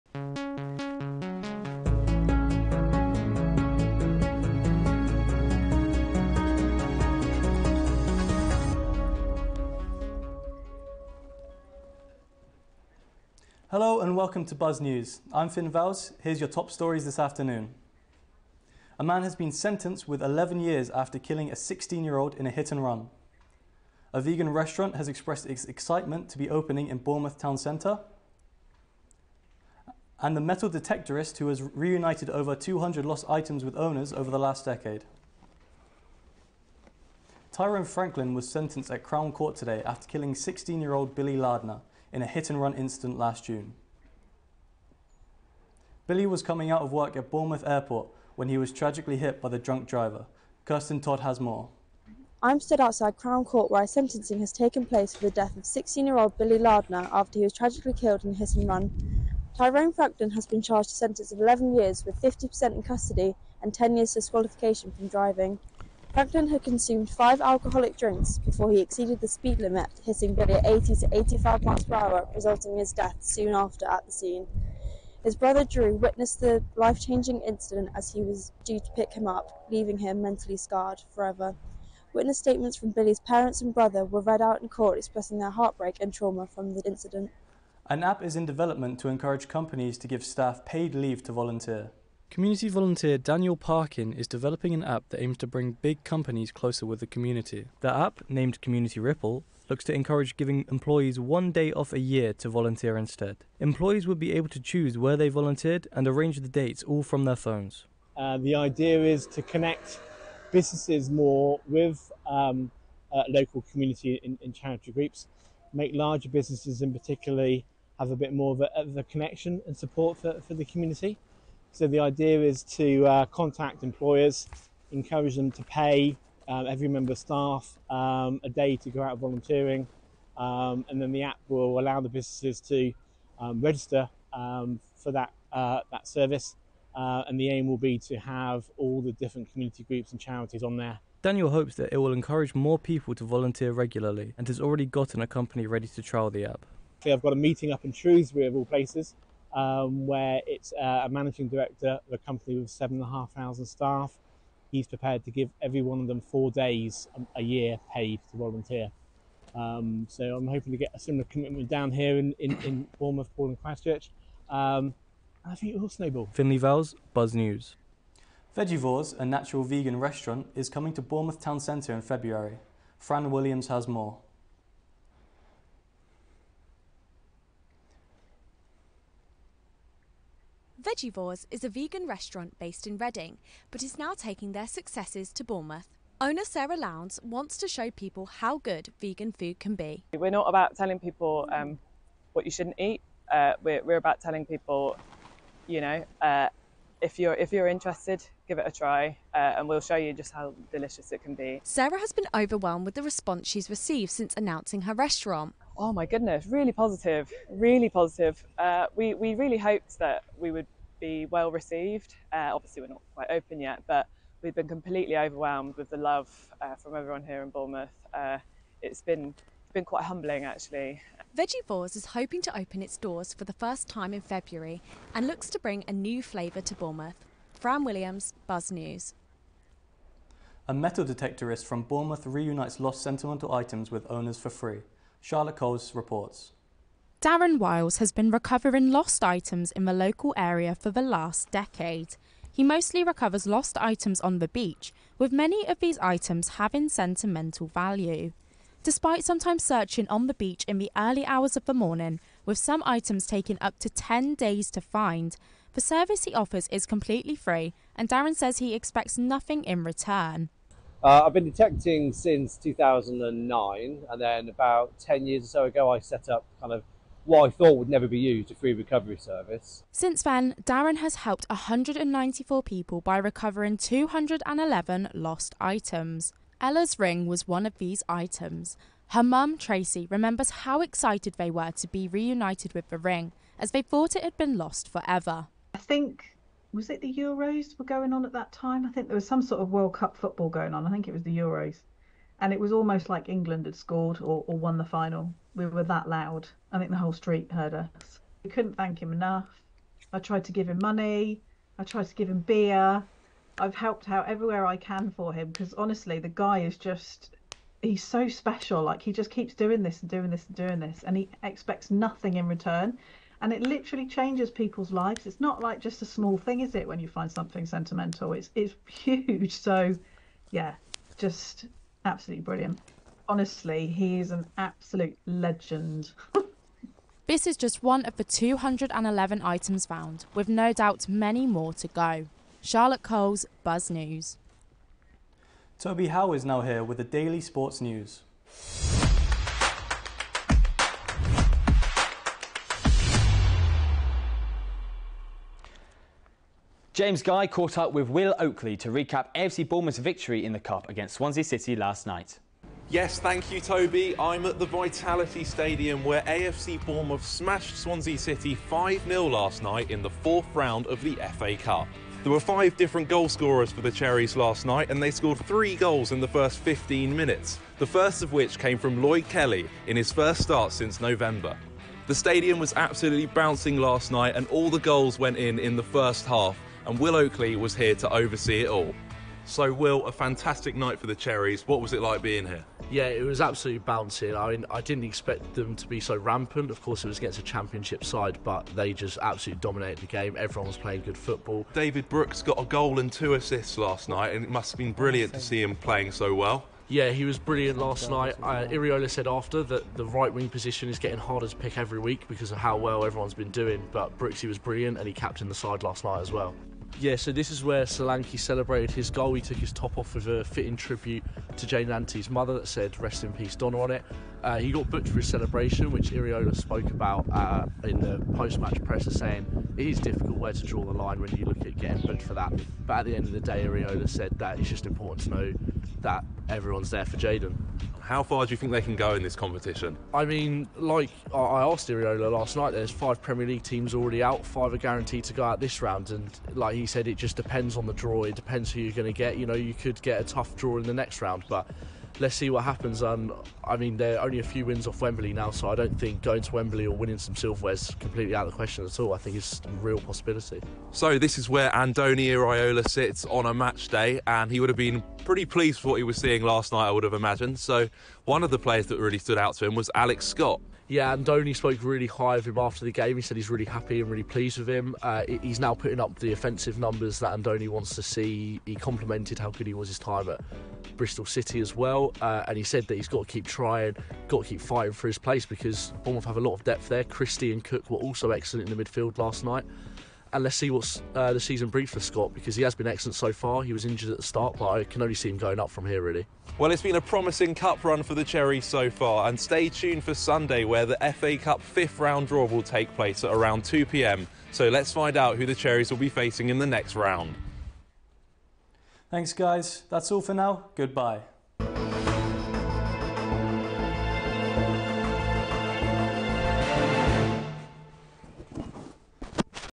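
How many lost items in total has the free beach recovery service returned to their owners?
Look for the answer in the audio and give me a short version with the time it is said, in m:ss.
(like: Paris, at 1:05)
211, at 4:33.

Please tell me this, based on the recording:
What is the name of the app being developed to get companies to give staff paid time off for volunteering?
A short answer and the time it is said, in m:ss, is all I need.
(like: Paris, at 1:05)
Community Ripple, at 1:38.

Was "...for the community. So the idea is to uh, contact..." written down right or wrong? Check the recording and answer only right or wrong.
right.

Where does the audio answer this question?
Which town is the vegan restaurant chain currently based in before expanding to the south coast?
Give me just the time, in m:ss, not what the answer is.
3:02.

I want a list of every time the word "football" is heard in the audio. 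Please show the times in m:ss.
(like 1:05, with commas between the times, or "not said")
4:50, 6:31.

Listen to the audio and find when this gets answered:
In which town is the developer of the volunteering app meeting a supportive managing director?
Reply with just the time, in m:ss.
2:27.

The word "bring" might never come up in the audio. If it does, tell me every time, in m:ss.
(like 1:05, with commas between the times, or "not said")
1:35, 3:45, 8:01.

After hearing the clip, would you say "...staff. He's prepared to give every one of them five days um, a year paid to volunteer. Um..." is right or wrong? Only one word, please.
wrong.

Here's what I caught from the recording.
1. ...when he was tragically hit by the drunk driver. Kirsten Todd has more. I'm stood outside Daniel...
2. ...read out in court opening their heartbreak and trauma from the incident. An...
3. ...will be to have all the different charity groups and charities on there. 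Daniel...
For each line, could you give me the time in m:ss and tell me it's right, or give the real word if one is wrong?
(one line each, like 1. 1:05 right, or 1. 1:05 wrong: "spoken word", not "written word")
1. 0:48 wrong: "Crown", not "Daniel"
2. 1:24 wrong: "expressing", not "opening"
3. 2:17 wrong: "community", not "charity".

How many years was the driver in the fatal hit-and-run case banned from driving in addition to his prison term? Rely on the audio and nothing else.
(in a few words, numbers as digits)
10 years.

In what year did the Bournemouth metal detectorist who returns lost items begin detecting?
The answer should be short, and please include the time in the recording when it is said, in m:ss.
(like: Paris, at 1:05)
2009, at 4:22.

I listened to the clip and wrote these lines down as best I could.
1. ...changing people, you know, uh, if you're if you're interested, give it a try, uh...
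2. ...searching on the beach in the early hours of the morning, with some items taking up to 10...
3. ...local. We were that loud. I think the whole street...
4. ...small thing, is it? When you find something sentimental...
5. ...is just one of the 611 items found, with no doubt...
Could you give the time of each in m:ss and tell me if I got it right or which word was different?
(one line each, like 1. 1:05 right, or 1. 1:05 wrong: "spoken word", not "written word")
1. 3:14 wrong: "telling", not "changing"
2. 4:09 right
3. 4:54 wrong: "final", not "local"
4. 5:16 right
5. 5:27 wrong: "211", not "611".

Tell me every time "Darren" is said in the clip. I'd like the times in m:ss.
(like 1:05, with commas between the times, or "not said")
3:57, 4:18, 4:30.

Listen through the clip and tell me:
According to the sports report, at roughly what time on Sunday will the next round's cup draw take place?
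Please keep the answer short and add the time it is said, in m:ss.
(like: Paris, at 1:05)
2 pm, at 8:13.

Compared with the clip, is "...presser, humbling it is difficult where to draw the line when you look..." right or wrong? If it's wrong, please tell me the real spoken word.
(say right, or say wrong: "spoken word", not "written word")
wrong: "saying", not "humbling".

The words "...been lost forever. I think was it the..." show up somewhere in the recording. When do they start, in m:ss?
4:44.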